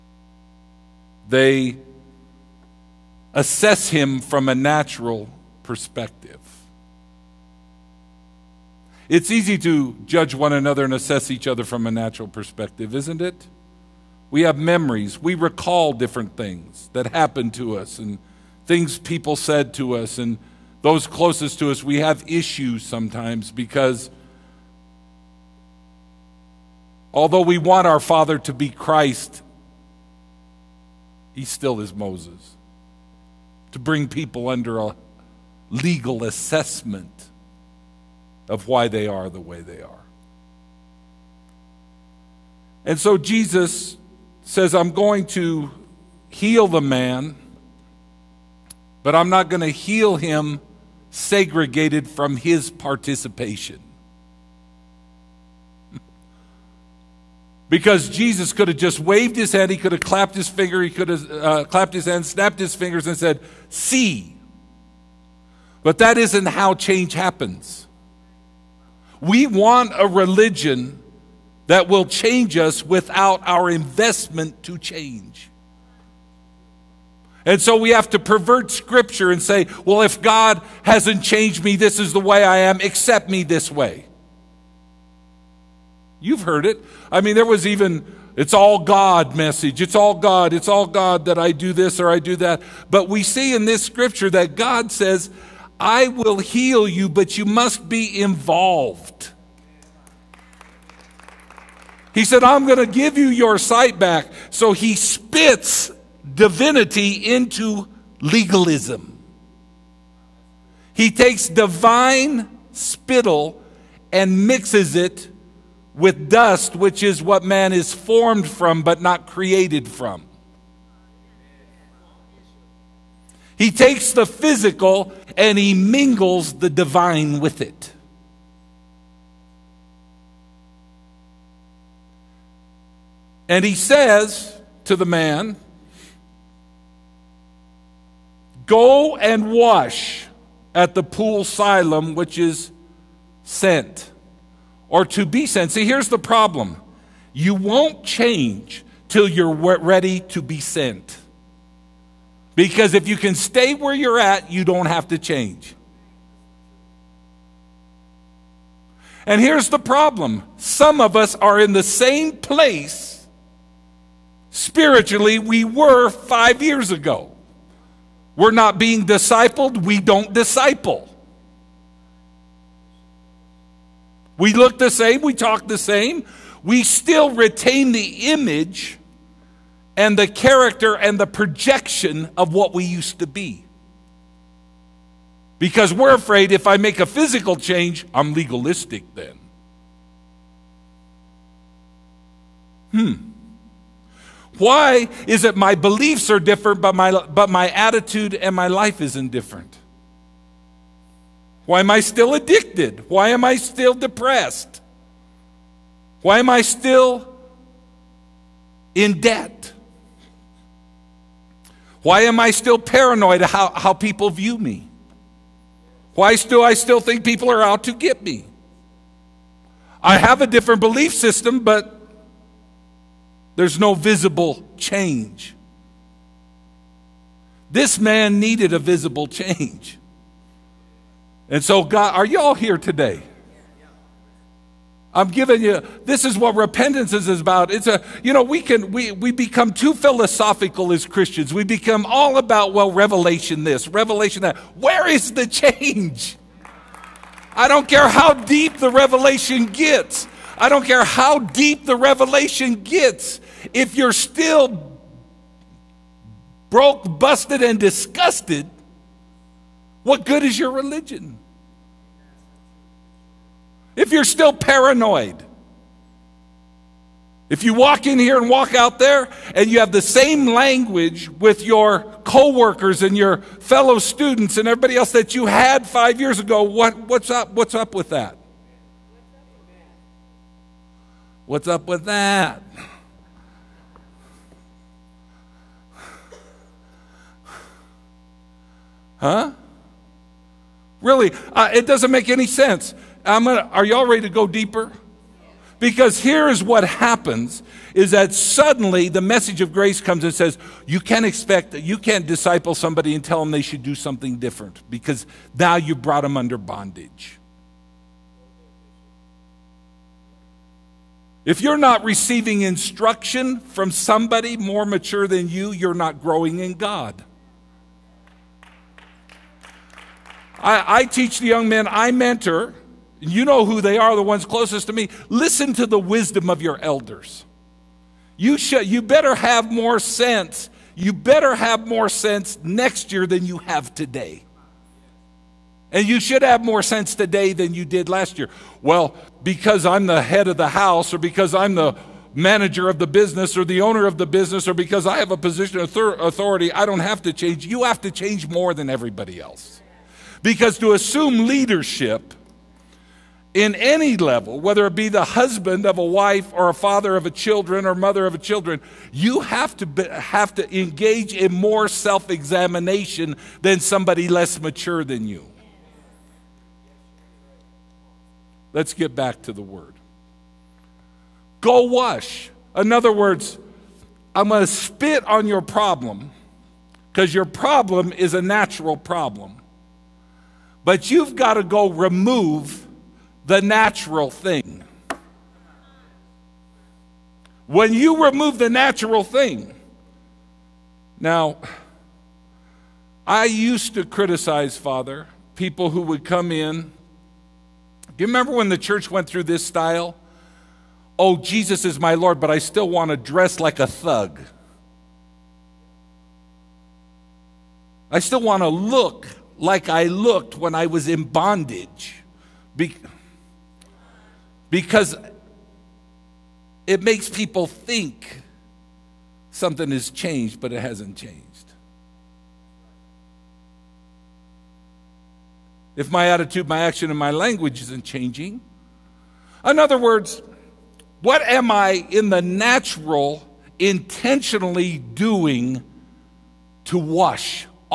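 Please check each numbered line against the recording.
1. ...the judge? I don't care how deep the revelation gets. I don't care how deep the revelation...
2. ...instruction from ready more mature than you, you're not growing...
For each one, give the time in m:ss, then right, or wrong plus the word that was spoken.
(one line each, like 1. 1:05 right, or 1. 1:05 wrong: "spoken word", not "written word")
1. 4:05 wrong: "change", not "judge"
2. 5:12 wrong: "somebody", not "ready".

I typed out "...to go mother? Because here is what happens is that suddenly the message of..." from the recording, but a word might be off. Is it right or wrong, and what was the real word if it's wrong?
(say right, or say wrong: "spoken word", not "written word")
wrong: "deeper", not "mother".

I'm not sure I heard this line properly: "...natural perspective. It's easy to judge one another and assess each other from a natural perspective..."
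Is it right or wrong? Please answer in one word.
right.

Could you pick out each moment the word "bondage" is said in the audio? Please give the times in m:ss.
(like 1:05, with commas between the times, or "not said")
5:06, 6:51.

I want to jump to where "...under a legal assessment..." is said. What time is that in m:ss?
0:34.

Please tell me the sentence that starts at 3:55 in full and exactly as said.
I'm giving you this is what repentance is about.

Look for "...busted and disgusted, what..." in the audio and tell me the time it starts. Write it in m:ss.
4:17.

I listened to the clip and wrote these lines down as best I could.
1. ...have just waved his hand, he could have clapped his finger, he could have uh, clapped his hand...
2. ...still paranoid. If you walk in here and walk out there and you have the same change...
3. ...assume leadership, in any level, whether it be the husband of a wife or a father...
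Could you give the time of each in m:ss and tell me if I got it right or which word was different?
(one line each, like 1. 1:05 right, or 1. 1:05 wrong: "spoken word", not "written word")
1. 0:58 right
2. 4:24 wrong: "language", not "change"
3. 5:50 right.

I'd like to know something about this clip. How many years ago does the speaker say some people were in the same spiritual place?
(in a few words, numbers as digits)
5.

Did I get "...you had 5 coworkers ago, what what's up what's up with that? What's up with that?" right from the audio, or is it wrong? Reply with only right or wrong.
wrong.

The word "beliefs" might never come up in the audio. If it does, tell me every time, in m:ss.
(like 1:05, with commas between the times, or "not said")
3:15, 3:40.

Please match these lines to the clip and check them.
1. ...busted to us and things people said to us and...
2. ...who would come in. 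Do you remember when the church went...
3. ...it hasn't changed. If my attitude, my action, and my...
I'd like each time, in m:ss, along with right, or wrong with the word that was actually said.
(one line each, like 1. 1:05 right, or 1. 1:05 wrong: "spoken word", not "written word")
1. 0:17 wrong: "happened", not "busted"
2. 6:35 right
3. 7:00 right.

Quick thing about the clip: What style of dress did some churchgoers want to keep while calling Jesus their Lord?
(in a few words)
a thug.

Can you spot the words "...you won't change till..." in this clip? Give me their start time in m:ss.
2:27.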